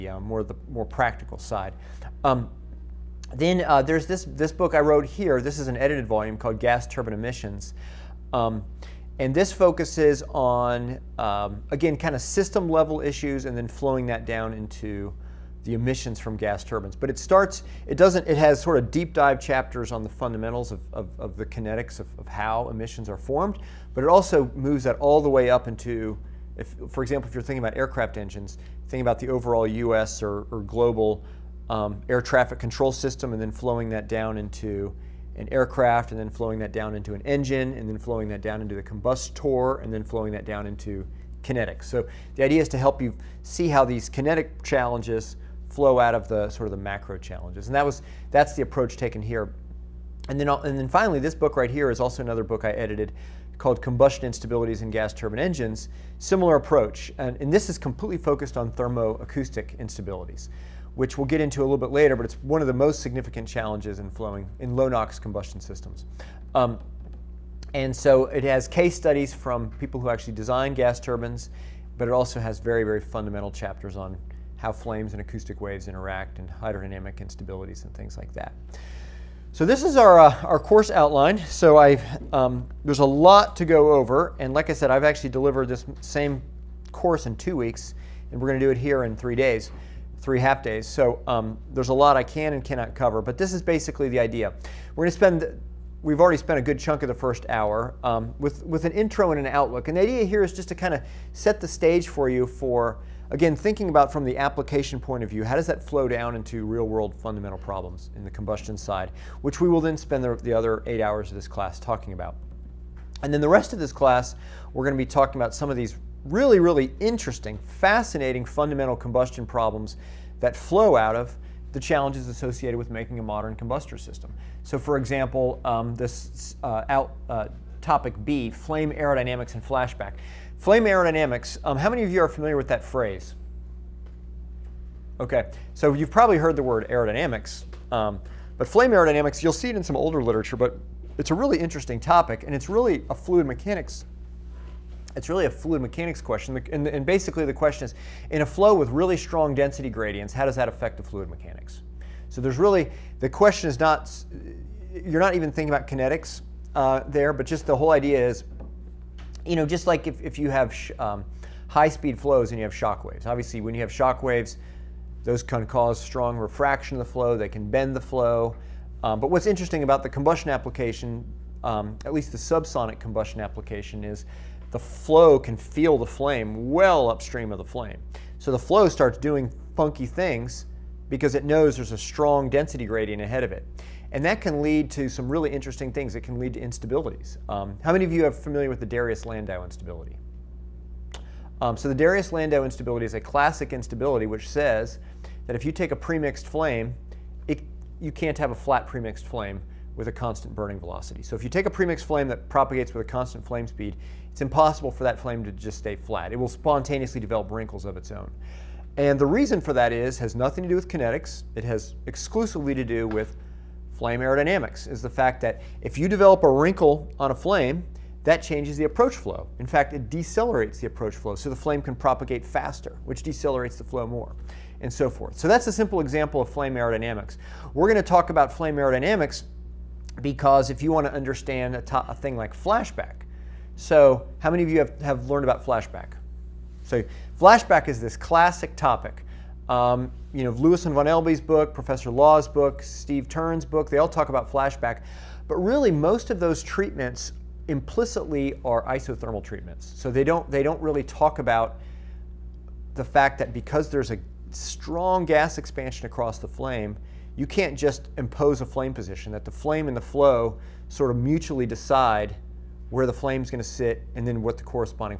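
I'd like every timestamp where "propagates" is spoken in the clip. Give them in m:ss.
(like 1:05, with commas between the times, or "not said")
3:22, 3:41.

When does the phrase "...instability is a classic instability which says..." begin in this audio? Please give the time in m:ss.
3:12.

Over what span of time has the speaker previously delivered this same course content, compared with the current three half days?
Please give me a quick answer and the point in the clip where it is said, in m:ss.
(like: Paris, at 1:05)
two weeks, at 1:27.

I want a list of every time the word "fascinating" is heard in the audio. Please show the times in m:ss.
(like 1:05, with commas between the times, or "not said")
1:57.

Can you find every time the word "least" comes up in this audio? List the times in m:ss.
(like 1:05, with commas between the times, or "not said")
2:52.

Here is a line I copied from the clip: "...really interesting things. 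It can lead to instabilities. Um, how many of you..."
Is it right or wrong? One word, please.
right.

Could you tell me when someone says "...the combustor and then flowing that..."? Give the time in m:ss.
0:38.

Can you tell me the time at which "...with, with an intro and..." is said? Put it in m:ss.
1:38.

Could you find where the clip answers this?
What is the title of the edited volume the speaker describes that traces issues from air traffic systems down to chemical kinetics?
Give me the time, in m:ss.
0:06.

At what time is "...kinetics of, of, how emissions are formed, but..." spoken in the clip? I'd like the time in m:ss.
0:21.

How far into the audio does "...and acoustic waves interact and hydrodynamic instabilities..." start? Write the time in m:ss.
1:15.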